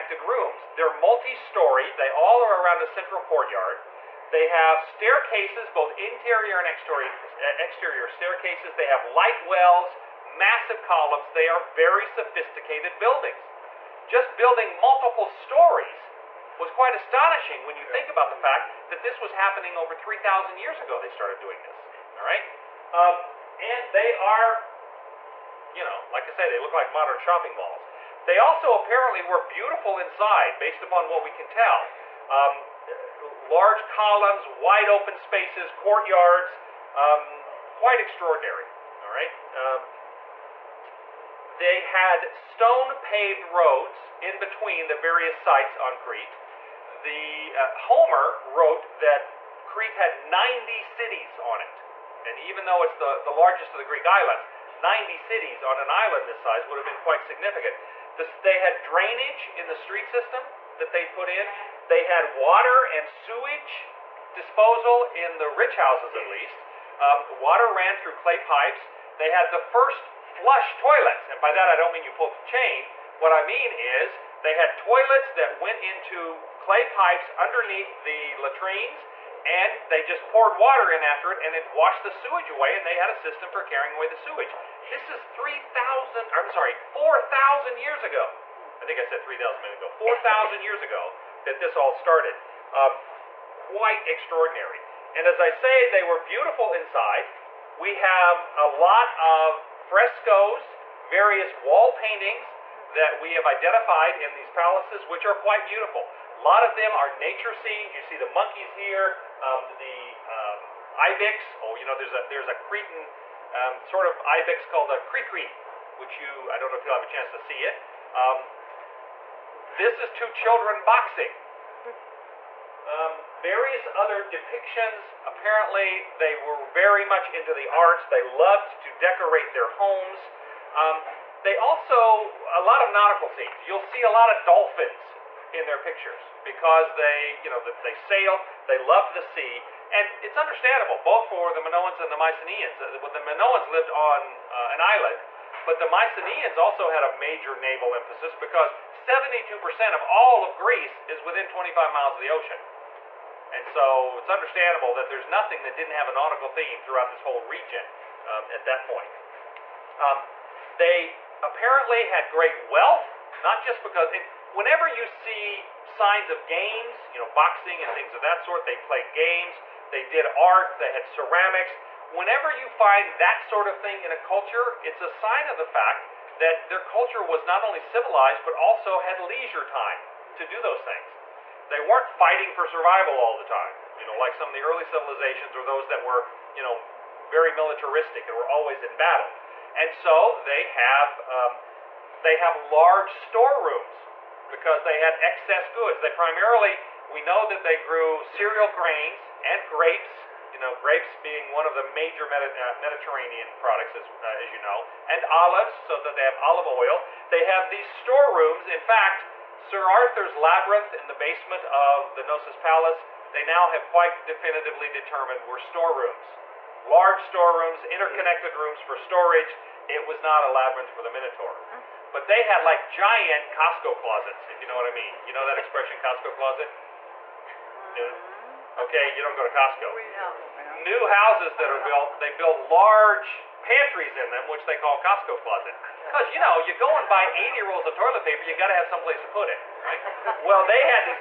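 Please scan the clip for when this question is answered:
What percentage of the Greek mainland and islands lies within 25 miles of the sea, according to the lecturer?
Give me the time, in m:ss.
2:28.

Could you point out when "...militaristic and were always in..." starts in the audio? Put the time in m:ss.
3:07.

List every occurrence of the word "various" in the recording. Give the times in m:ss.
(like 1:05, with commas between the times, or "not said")
0:44, 1:41, 2:03.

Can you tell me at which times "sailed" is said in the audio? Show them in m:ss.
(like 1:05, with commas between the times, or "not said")
2:17.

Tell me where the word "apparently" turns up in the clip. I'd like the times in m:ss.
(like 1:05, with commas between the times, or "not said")
0:28, 2:05, 2:41.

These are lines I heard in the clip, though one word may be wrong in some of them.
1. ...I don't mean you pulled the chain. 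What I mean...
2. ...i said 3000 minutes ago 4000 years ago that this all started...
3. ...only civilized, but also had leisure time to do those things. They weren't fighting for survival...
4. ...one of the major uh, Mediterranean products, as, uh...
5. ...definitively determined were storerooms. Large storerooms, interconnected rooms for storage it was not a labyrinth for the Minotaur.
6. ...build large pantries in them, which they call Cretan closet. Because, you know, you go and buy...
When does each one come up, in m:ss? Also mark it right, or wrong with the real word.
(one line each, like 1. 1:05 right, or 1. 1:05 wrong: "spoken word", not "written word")
1. 1:11 right
2. 1:28 right
3. 2:57 right
4. 3:21 right
5. 3:34 right
6. 3:52 wrong: "Costco", not "Cretan".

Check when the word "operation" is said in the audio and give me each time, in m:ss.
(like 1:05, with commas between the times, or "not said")
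not said.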